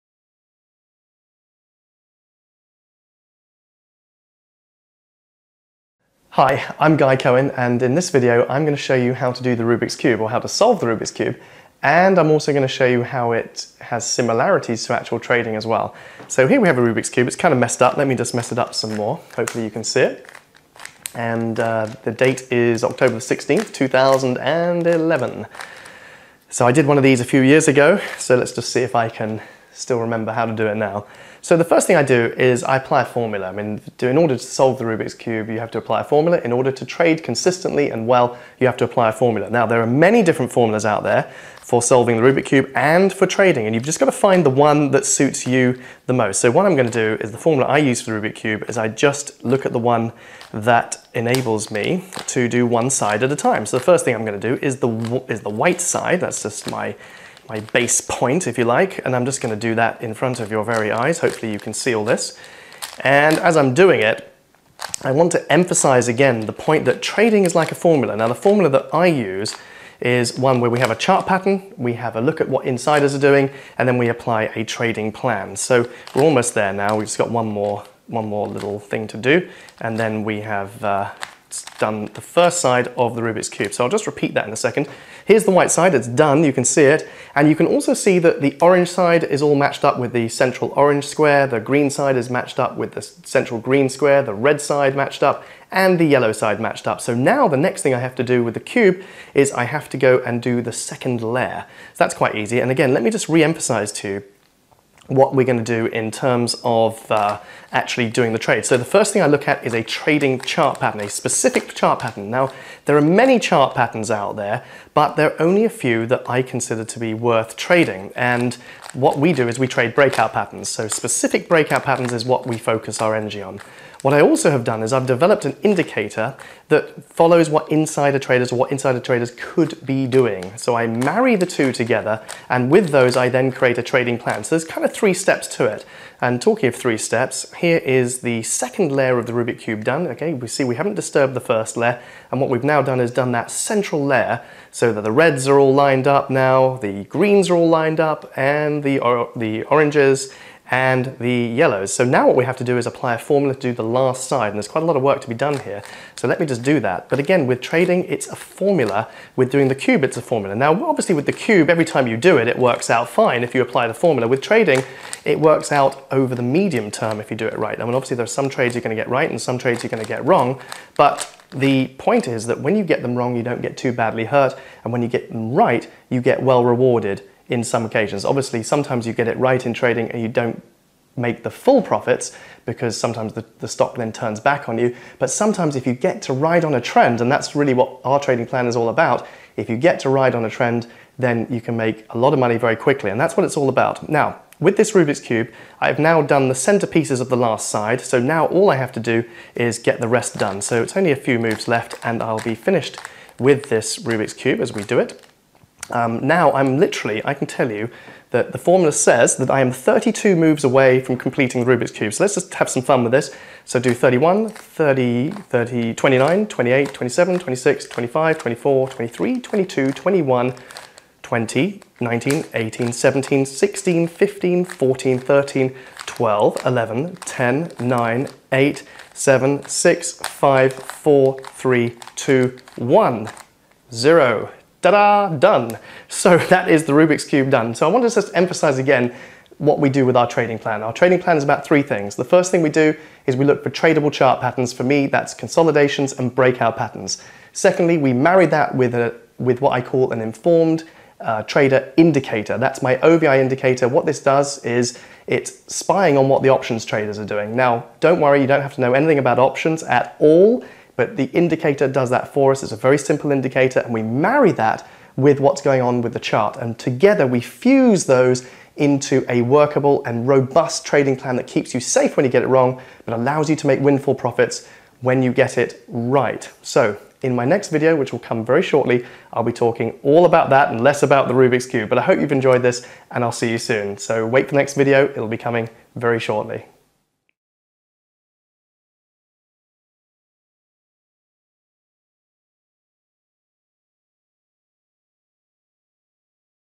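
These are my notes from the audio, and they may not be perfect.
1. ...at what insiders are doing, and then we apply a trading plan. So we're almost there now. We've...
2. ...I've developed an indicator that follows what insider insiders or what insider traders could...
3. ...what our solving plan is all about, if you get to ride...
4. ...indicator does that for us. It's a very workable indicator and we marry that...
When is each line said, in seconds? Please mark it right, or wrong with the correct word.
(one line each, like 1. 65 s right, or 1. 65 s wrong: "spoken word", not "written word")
1. 72 s right
2. 124 s wrong: "traders", not "insiders"
3. 187 s wrong: "trading", not "solving"
4. 261 s wrong: "simple", not "workable".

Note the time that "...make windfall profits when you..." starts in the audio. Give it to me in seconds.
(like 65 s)
273 s.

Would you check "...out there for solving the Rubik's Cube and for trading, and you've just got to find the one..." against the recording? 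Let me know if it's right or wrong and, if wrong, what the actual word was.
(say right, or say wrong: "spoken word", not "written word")
right.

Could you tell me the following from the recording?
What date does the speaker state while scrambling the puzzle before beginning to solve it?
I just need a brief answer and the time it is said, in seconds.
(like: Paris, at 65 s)
October 16th, 2011, at 22 s.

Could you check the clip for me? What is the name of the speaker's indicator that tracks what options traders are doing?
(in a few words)
OVI indicator.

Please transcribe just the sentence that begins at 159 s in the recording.
With doing the cube, it's a formula.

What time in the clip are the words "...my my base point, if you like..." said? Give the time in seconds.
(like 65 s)
56 s.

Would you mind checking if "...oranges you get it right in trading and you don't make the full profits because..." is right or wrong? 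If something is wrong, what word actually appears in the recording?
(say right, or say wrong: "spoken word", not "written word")
wrong: "sometimes", not "oranges".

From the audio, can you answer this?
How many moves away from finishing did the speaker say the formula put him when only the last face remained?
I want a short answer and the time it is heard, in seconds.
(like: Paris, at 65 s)
32, at 209 s.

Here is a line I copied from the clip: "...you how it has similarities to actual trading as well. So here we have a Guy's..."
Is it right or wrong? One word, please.
wrong.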